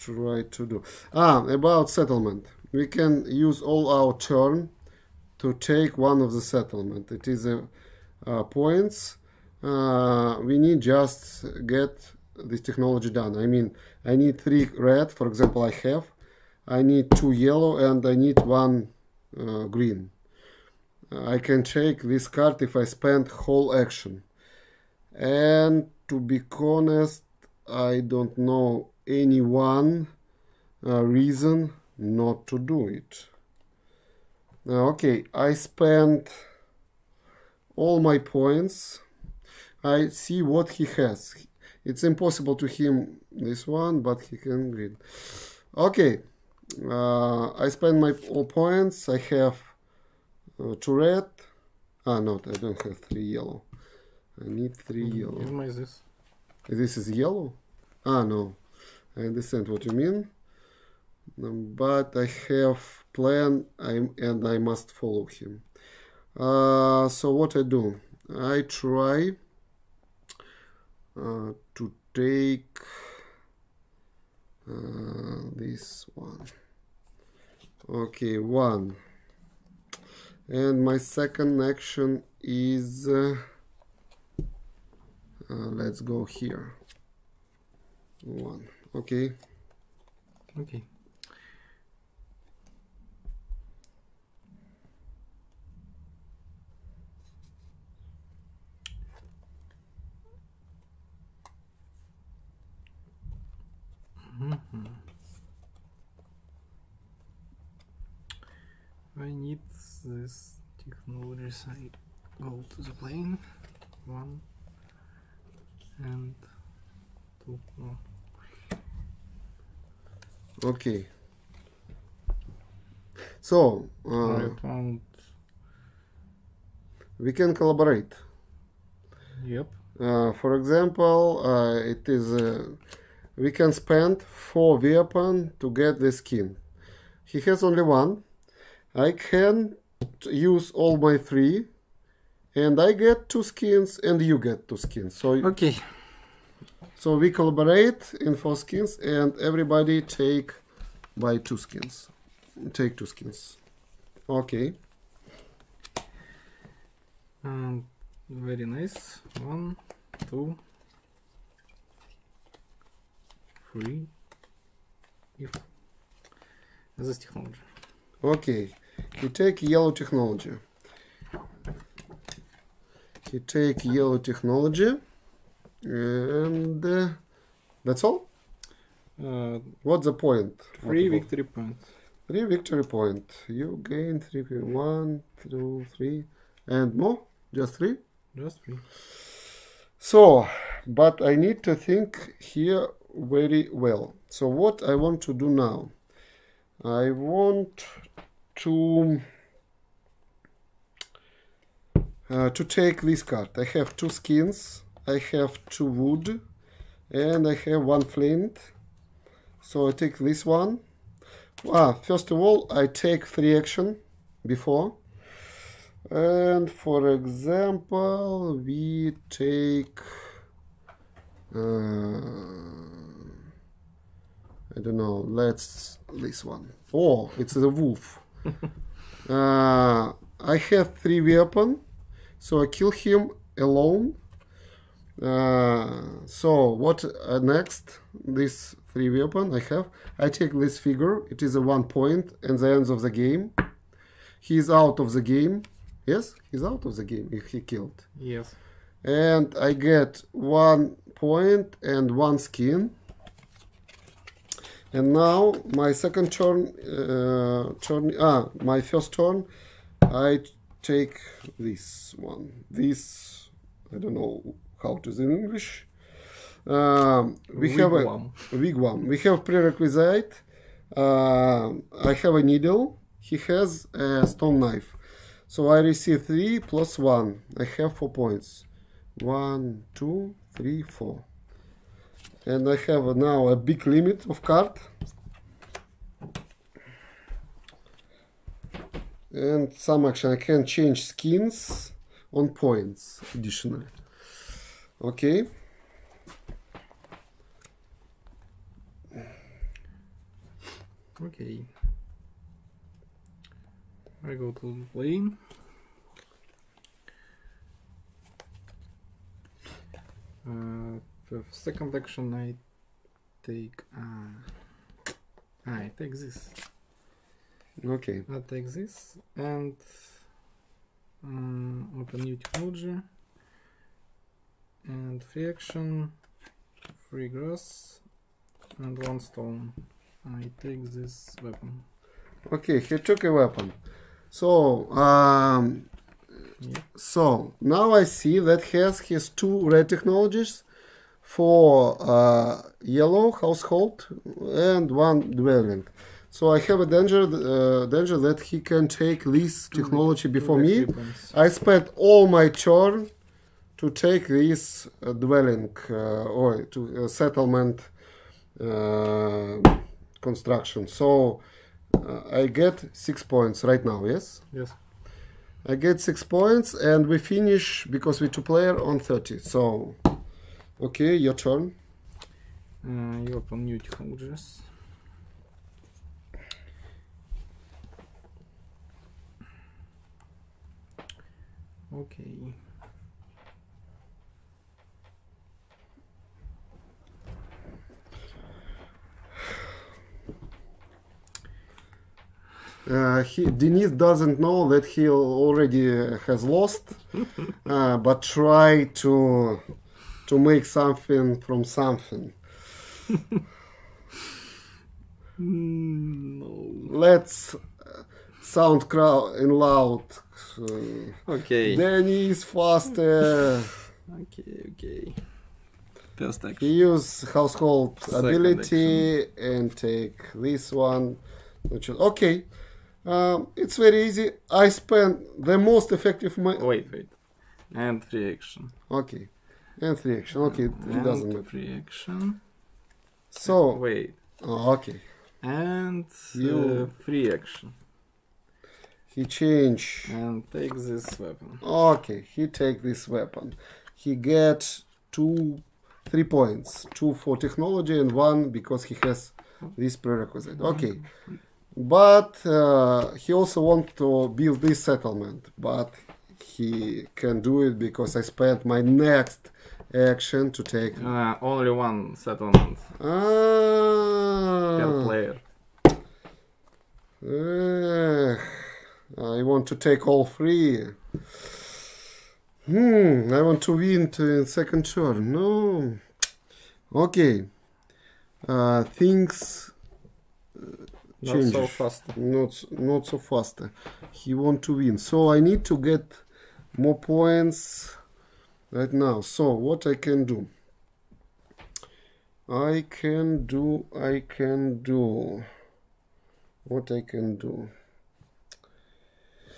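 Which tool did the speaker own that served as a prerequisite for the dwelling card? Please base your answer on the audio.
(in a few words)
Needle.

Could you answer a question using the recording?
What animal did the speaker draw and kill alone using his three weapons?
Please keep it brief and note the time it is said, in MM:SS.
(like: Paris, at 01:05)
Wolf, at 03:47.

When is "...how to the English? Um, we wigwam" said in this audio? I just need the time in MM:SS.
04:24.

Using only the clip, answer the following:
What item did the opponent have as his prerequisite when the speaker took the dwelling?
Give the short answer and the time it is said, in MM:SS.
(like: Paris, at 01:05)
Stone knife, at 04:34.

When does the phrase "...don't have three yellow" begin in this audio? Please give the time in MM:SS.
00:52.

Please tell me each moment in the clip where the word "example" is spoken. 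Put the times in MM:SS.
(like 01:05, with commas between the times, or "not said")
00:15, 02:10, 03:37.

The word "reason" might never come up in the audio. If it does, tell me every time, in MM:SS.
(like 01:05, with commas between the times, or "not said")
00:31.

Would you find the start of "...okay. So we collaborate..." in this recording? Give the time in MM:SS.
02:25.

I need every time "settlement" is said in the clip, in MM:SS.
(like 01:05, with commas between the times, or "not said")
00:01, 00:06, 05:57, 07:34, 07:42.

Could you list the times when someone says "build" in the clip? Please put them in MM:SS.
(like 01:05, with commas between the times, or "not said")
07:34.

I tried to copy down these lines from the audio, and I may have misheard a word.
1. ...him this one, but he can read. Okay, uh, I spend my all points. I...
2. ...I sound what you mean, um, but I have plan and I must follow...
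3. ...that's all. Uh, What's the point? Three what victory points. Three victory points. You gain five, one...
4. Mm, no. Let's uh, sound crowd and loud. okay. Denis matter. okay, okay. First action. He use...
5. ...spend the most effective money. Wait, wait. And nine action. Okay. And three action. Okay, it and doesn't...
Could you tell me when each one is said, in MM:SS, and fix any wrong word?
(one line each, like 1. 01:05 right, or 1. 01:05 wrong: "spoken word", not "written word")
1. 00:42 right
2. 00:59 wrong: "understand", not "sound"
3. 02:57 wrong: "three", not "five"
4. 06:45 wrong: "faster", not "matter"
5. 07:04 wrong: "three", not "nine".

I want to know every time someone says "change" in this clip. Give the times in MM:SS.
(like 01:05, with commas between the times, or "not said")
04:50, 07:19, 08:01.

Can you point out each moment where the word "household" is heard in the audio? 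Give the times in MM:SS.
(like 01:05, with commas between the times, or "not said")
05:43, 06:57.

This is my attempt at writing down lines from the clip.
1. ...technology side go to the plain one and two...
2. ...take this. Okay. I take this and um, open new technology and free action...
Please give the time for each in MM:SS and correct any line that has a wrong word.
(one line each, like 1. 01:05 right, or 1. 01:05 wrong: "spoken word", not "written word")
1. 01:50 right
2. 05:15 right.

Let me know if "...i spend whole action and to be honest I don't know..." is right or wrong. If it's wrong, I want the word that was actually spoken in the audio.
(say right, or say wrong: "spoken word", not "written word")
right.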